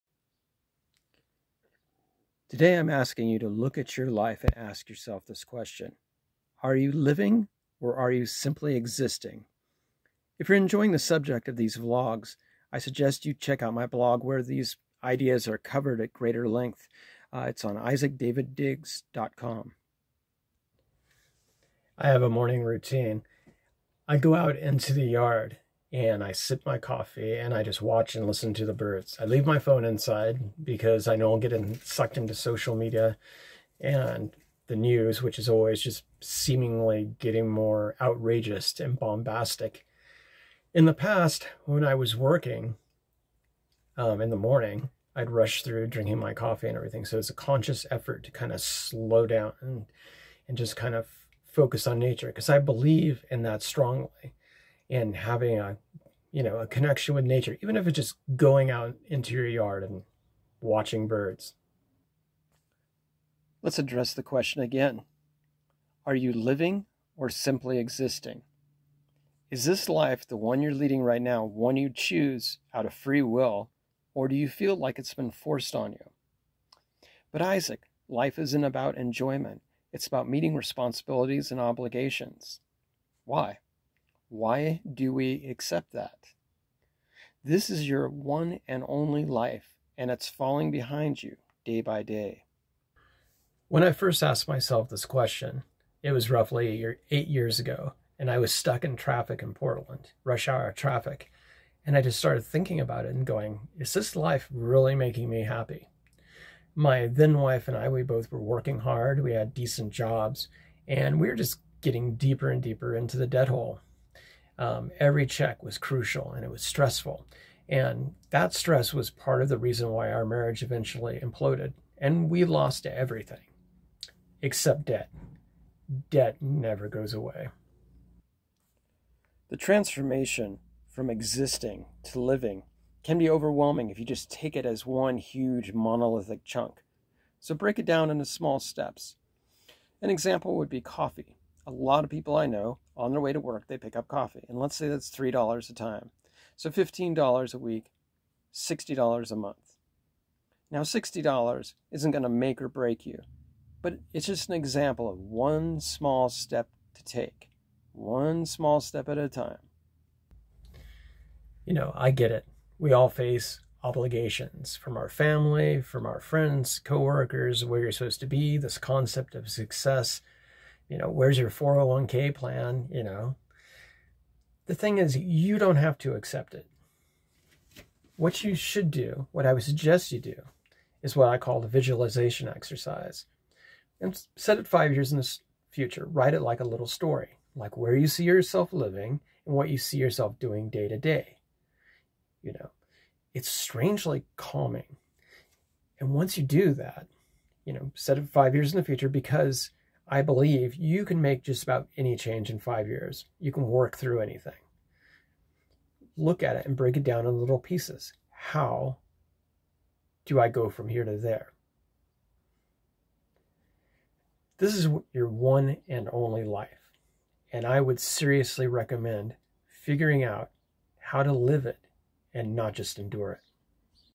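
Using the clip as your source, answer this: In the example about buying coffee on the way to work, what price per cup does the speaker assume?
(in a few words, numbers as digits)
$3.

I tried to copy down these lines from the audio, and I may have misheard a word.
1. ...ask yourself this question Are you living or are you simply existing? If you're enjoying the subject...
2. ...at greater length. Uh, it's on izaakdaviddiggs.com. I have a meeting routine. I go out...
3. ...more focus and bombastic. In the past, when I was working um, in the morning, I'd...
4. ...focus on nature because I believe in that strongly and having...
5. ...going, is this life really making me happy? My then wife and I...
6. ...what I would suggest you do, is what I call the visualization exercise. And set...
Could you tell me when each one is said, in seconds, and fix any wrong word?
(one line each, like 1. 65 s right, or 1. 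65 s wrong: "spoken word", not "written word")
1. 4 s right
2. 16 s wrong: "morning", not "meeting"
3. 37 s wrong: "outrageous", not "focus"
4. 51 s right
5. 103 s right
6. 179 s right.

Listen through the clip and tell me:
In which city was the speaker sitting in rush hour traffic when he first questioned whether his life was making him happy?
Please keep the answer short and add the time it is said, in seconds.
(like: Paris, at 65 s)
Portland, at 99 s.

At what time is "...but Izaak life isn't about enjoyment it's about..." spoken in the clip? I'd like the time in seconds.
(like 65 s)
77 s.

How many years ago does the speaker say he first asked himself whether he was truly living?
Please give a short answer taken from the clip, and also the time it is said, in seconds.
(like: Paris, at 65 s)
8, at 97 s.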